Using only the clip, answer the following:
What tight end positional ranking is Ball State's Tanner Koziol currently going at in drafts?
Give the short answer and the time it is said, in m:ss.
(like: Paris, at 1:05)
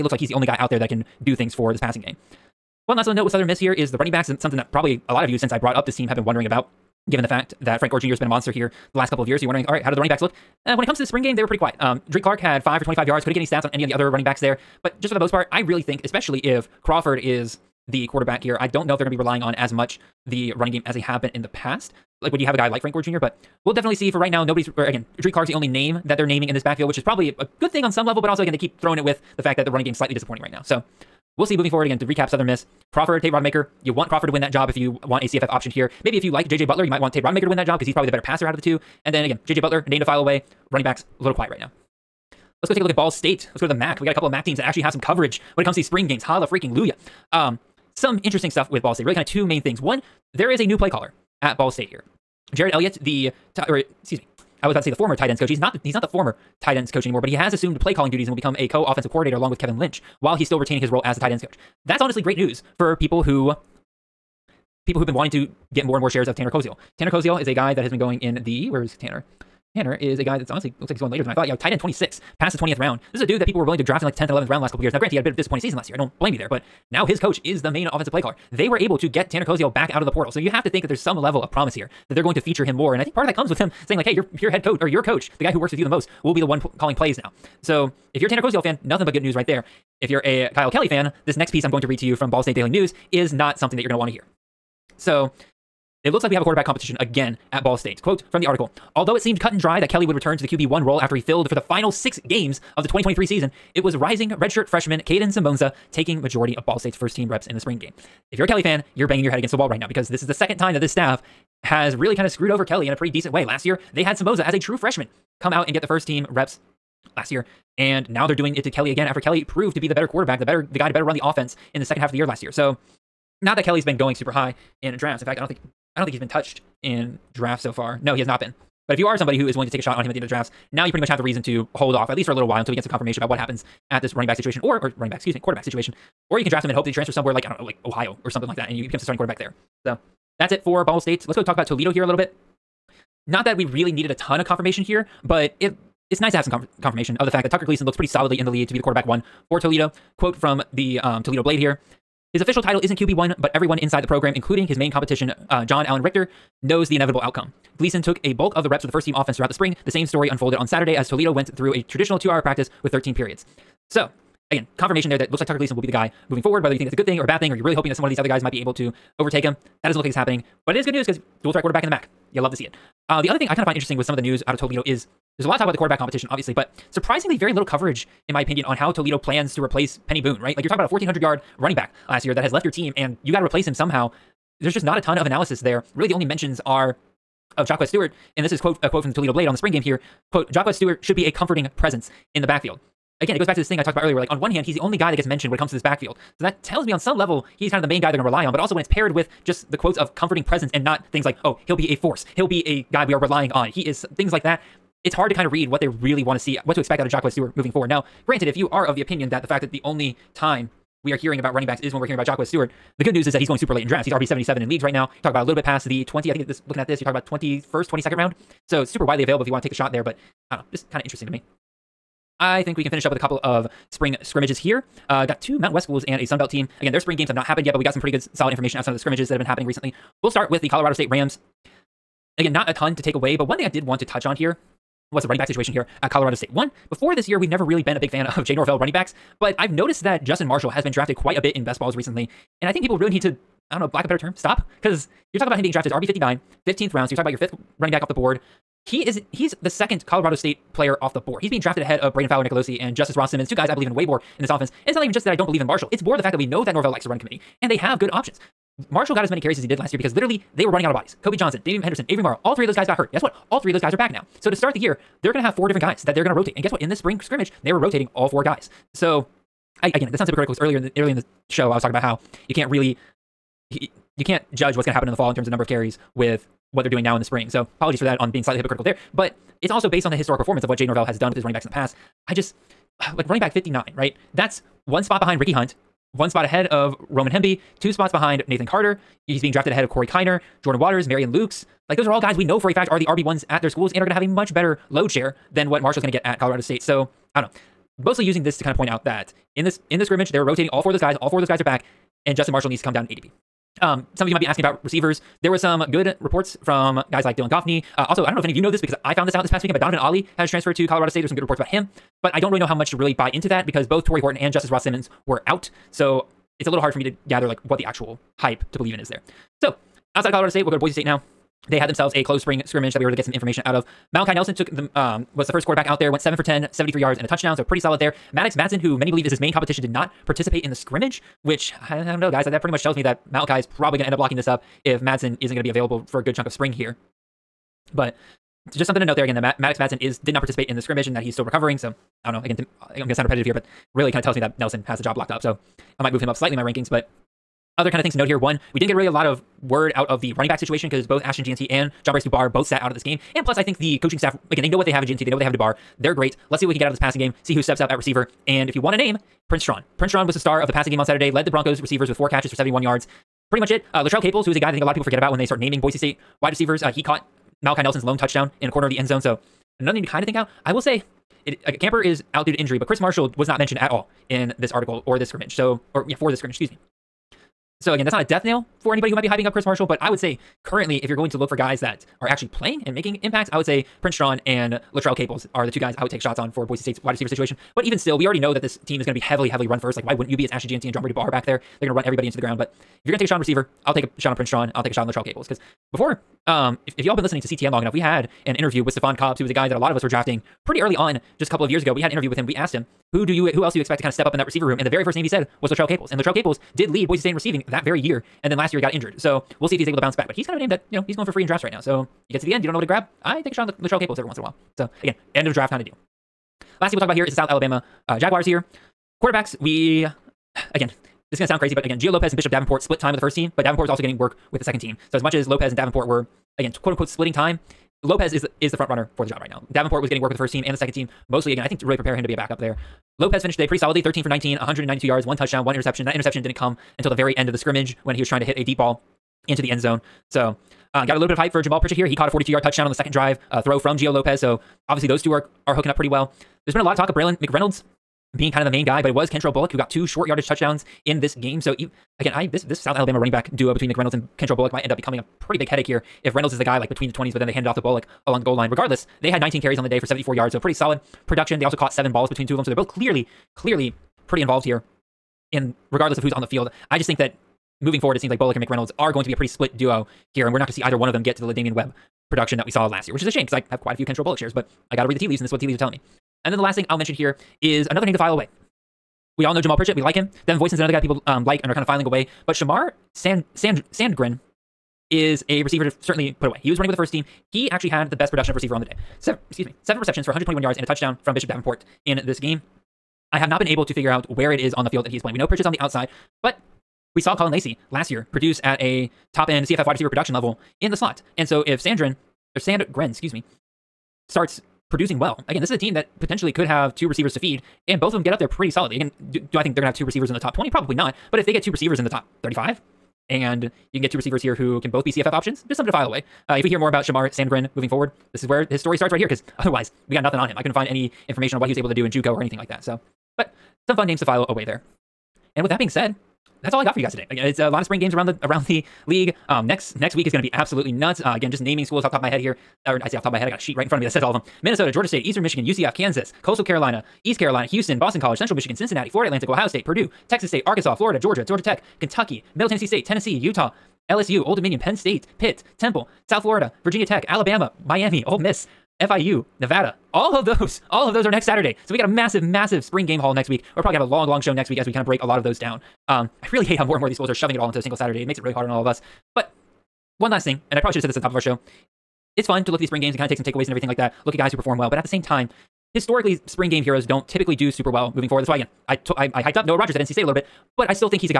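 Tight end 26, at 1:11.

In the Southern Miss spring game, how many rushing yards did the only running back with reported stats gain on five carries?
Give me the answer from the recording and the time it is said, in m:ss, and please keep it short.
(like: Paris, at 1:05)
25, at 0:12.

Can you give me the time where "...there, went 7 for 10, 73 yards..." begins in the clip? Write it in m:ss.
5:25.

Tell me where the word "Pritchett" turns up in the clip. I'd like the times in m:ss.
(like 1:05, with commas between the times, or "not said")
7:21, 7:59.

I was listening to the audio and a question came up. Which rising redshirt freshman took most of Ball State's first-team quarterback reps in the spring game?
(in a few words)
Kadin Semonza.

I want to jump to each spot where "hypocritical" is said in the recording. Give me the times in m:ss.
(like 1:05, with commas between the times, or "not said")
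4:30, 4:38.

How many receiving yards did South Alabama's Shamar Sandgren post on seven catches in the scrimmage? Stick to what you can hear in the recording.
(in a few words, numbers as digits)
121.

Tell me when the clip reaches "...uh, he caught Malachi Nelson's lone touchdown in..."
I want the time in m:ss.
6:06.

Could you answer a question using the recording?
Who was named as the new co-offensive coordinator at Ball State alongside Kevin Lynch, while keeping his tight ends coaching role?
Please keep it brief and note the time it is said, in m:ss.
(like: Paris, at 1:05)
Jared Elliott, at 0:52.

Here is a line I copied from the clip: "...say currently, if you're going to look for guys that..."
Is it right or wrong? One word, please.
right.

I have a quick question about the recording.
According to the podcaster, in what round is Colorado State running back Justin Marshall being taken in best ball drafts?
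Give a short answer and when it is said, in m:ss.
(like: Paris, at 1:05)
15th round, at 4:06.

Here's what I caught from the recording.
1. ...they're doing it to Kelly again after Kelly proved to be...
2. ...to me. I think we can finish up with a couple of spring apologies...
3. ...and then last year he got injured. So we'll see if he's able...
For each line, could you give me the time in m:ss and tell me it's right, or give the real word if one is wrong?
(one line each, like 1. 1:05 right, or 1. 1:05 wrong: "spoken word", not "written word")
1. 1:58 right
2. 3:41 wrong: "scrimmages", not "apologies"
3. 6:48 right.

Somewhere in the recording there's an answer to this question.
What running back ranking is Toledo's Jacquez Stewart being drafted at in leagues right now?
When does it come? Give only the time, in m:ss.
3:34.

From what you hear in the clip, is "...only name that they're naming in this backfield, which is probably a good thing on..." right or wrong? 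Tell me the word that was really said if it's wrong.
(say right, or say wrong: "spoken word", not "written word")
right.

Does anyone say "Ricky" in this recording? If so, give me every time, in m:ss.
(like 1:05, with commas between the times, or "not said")
4:45.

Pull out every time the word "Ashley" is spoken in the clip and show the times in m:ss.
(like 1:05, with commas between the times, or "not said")
6:30.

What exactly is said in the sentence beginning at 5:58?
And if you want a name, Prince Strachan.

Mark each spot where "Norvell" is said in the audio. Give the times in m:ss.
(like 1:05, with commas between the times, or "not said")
3:58, 4:16, 4:40.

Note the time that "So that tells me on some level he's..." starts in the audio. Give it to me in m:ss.
3:16.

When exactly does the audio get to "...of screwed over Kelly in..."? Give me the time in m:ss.
1:52.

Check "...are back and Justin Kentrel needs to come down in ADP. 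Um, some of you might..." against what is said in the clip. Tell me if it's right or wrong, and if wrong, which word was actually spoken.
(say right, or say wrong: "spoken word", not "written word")
wrong: "Marshall", not "Kentrel".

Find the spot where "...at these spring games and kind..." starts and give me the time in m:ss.
9:22.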